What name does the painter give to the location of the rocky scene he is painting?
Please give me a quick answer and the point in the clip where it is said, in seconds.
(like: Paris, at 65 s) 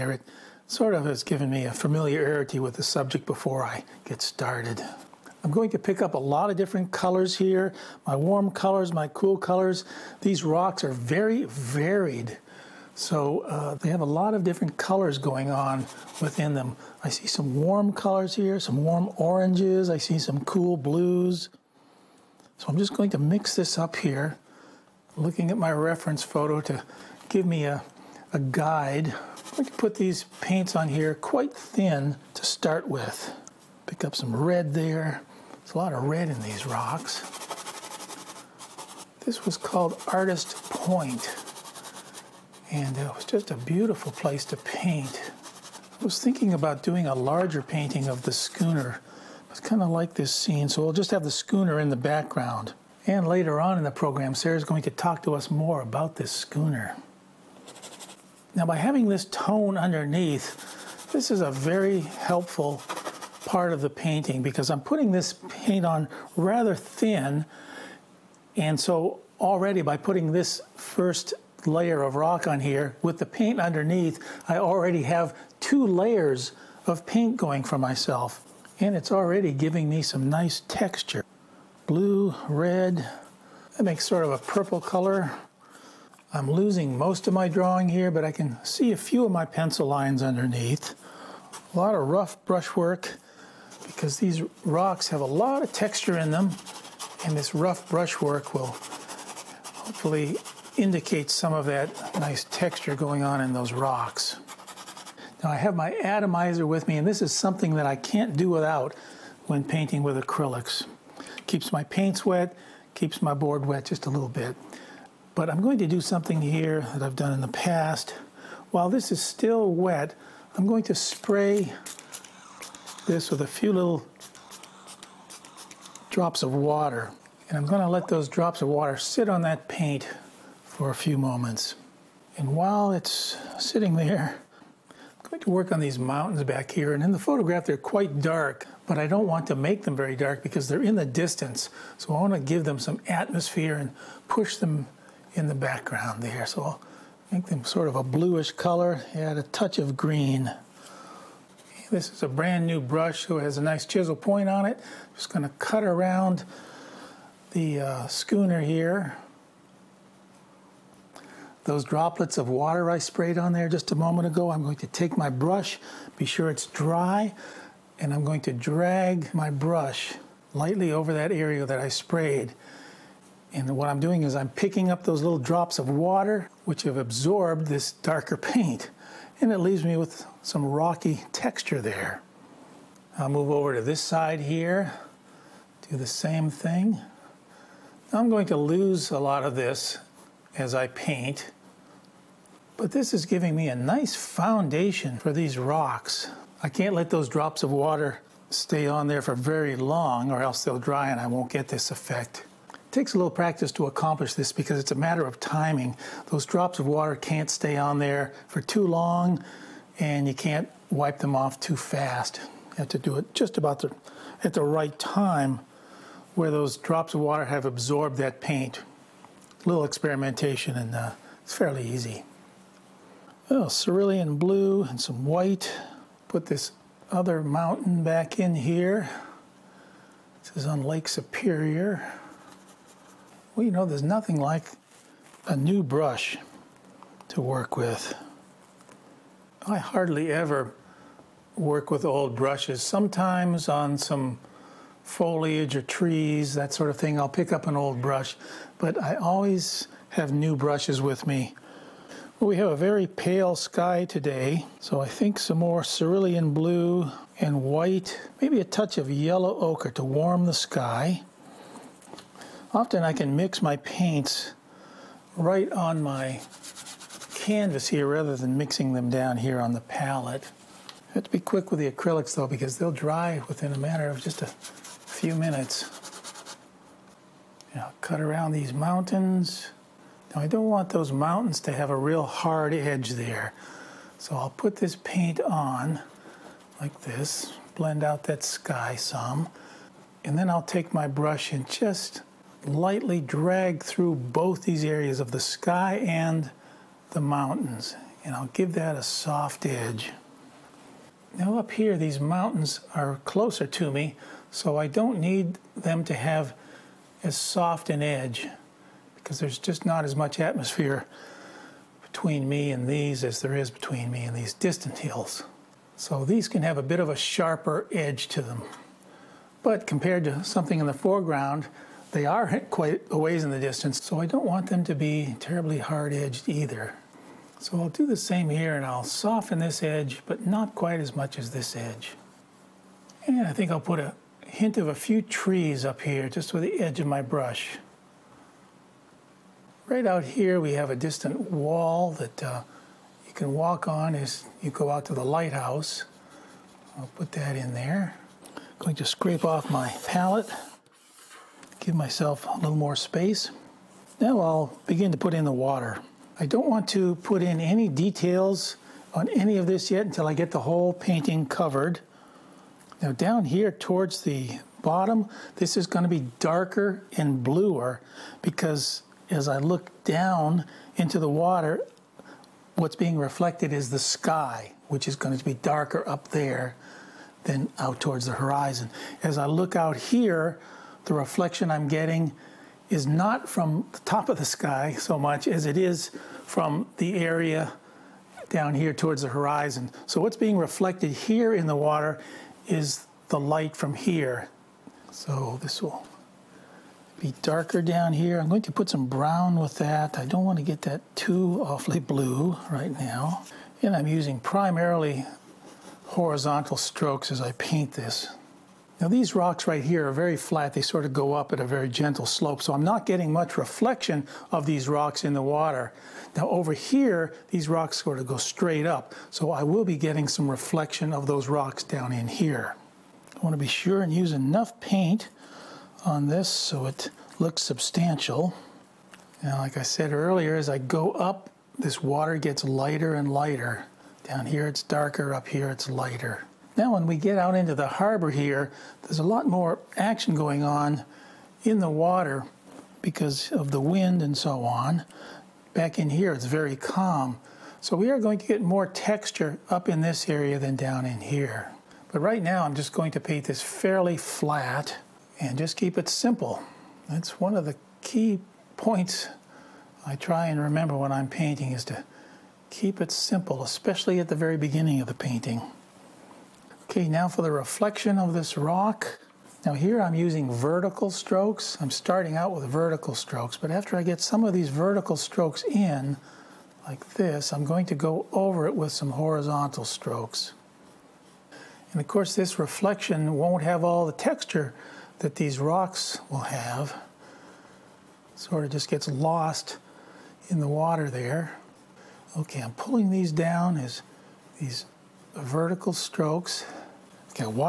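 Artist Point, at 40 s.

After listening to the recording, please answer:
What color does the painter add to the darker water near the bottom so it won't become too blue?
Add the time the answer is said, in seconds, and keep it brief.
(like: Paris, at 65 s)
brown, at 399 s.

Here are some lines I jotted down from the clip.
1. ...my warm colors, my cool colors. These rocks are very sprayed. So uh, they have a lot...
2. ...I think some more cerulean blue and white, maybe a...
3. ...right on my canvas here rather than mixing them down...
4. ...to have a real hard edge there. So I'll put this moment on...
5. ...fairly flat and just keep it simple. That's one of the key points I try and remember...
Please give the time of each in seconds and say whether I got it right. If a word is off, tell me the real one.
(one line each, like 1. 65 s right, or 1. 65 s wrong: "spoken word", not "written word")
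1. 8 s wrong: "varied", not "sprayed"
2. 254 s right
3. 265 s right
4. 281 s wrong: "paint", not "moment"
5. 453 s right.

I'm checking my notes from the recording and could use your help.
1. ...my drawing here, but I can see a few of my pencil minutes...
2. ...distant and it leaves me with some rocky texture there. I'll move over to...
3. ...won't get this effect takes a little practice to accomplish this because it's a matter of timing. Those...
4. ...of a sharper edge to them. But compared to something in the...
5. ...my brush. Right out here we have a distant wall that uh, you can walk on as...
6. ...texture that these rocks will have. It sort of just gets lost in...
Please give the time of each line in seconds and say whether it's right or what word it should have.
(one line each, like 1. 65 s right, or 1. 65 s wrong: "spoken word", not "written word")
1. 87 s wrong: "lines", not "minutes"
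2. 178 s wrong: "paint", not "distant"
3. 201 s right
4. 316 s right
5. 337 s right
6. 484 s right.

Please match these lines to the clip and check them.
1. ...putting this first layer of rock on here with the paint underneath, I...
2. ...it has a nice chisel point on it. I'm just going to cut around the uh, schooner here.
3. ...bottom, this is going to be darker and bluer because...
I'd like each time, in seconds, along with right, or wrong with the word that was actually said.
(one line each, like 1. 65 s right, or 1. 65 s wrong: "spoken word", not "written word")
1. 69 s right
2. 153 s right
3. 364 s right.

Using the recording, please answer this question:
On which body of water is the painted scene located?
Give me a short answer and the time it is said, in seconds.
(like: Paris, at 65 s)
Lake Superior, at 230 s.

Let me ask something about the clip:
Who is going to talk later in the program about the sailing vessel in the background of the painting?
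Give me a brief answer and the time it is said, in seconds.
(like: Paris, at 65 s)
Sarah, at 54 s.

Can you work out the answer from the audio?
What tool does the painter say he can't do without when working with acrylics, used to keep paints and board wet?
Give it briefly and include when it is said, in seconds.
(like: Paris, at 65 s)
atomizer, at 106 s.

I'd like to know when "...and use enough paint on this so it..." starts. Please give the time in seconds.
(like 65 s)
424 s.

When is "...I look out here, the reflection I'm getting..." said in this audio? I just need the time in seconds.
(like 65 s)
379 s.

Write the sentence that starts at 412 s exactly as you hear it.
So I'm not getting much reflection of these rocks in the water.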